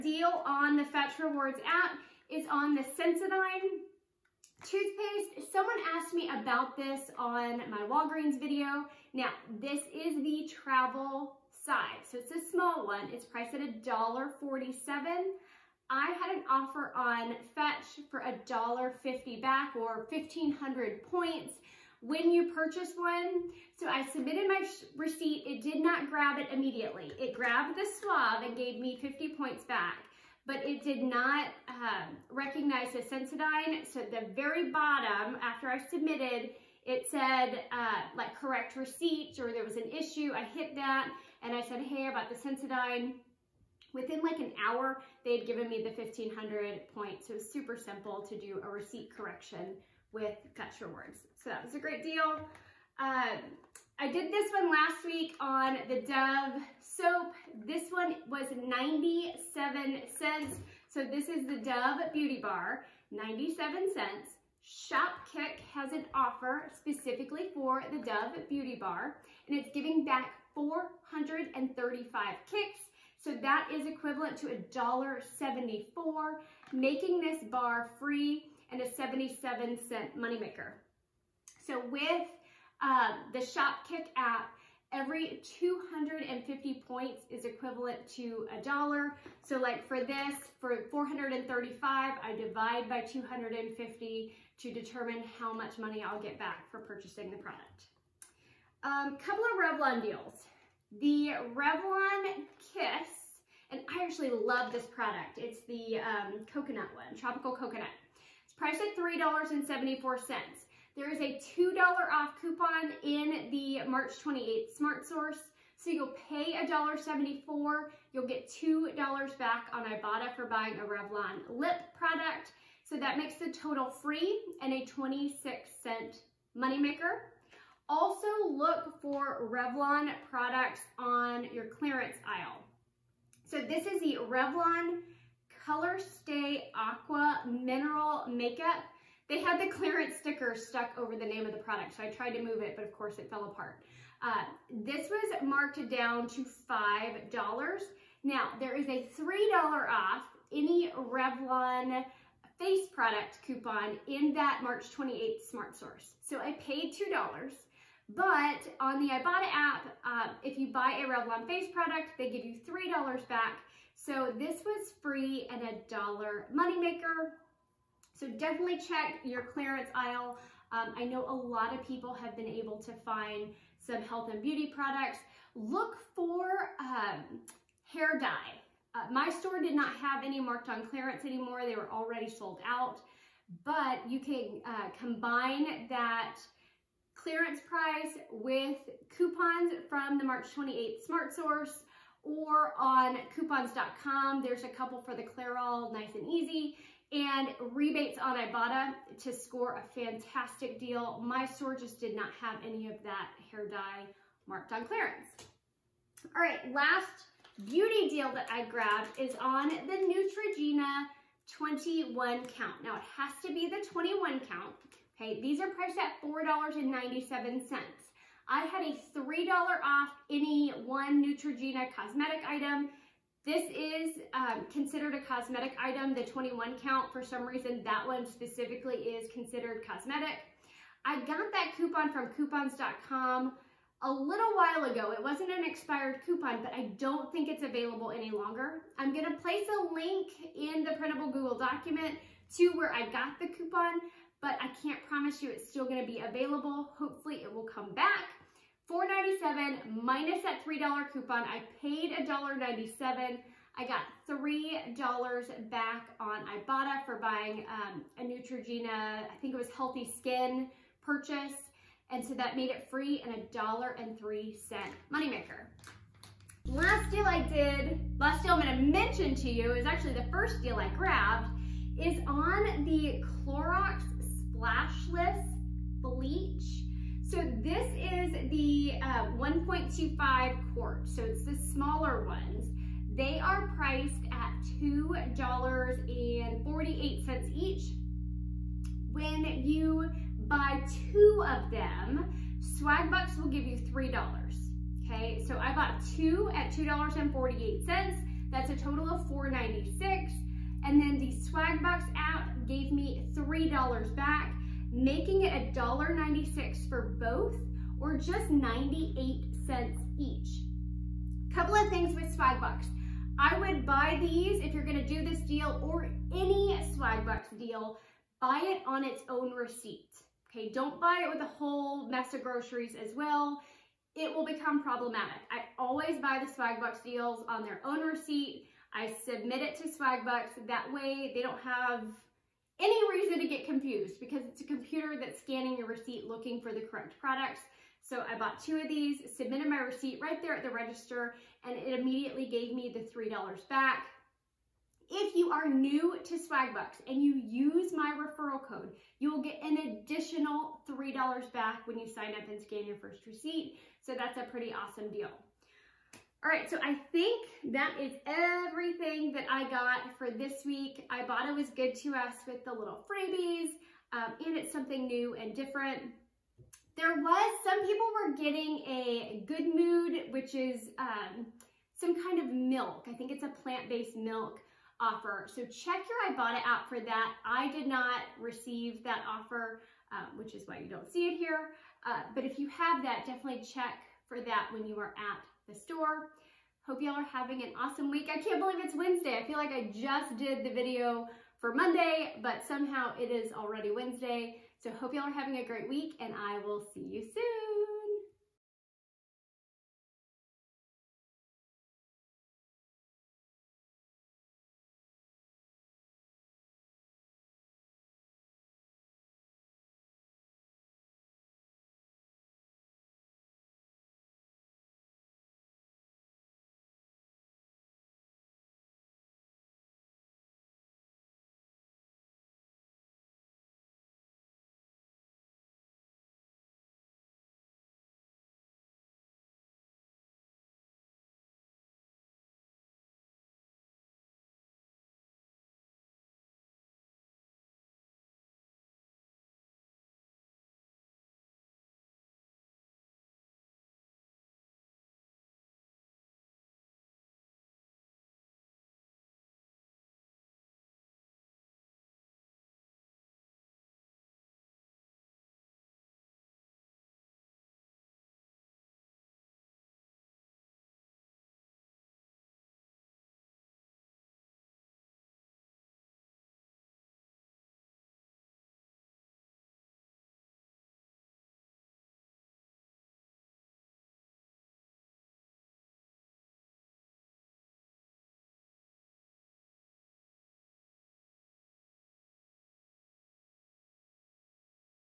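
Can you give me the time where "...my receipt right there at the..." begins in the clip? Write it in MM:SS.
05:39.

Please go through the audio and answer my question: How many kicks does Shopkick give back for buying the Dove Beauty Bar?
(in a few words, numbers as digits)
435.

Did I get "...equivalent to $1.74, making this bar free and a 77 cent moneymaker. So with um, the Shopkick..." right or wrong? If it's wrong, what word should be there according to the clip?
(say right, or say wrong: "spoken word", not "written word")
right.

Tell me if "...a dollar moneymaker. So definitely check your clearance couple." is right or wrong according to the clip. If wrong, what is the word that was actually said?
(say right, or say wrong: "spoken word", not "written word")
wrong: "aisle", not "couple".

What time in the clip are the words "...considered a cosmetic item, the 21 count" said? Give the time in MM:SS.
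03:44.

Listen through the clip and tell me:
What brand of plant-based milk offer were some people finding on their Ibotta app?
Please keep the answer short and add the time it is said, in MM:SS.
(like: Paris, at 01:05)
Good Mood, at 06:09.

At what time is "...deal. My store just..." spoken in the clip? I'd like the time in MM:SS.
03:20.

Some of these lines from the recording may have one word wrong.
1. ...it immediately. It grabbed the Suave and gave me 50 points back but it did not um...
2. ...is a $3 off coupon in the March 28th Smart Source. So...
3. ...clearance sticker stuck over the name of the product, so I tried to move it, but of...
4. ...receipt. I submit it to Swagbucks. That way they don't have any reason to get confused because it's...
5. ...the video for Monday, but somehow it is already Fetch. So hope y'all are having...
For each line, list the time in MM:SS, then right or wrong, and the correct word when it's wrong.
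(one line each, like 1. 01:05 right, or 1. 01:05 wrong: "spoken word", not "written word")
1. 00:26 right
2. 01:51 wrong: "2", not "3"
3. 02:19 right
4. 05:28 right
5. 06:30 wrong: "Wednesday", not "Fetch".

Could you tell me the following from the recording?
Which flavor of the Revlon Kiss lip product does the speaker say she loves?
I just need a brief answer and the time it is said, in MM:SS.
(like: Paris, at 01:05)
tropical coconut, at 01:47.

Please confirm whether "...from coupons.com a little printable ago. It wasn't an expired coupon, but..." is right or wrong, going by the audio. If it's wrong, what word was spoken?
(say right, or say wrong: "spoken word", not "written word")
wrong: "while", not "printable".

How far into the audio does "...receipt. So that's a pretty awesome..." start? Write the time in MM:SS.
05:53.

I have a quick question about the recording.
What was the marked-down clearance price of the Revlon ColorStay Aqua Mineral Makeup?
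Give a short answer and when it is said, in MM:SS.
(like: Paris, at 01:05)
$5, at 02:26.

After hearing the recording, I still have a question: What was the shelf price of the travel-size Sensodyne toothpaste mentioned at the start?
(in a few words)
$1.47.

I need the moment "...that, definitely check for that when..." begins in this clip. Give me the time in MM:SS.
06:23.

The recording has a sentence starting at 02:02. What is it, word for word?
So that makes the total free and a 26 cent moneymaker.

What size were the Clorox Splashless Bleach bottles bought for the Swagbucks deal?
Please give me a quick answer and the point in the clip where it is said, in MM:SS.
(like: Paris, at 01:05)
1.25 quart, at 04:39.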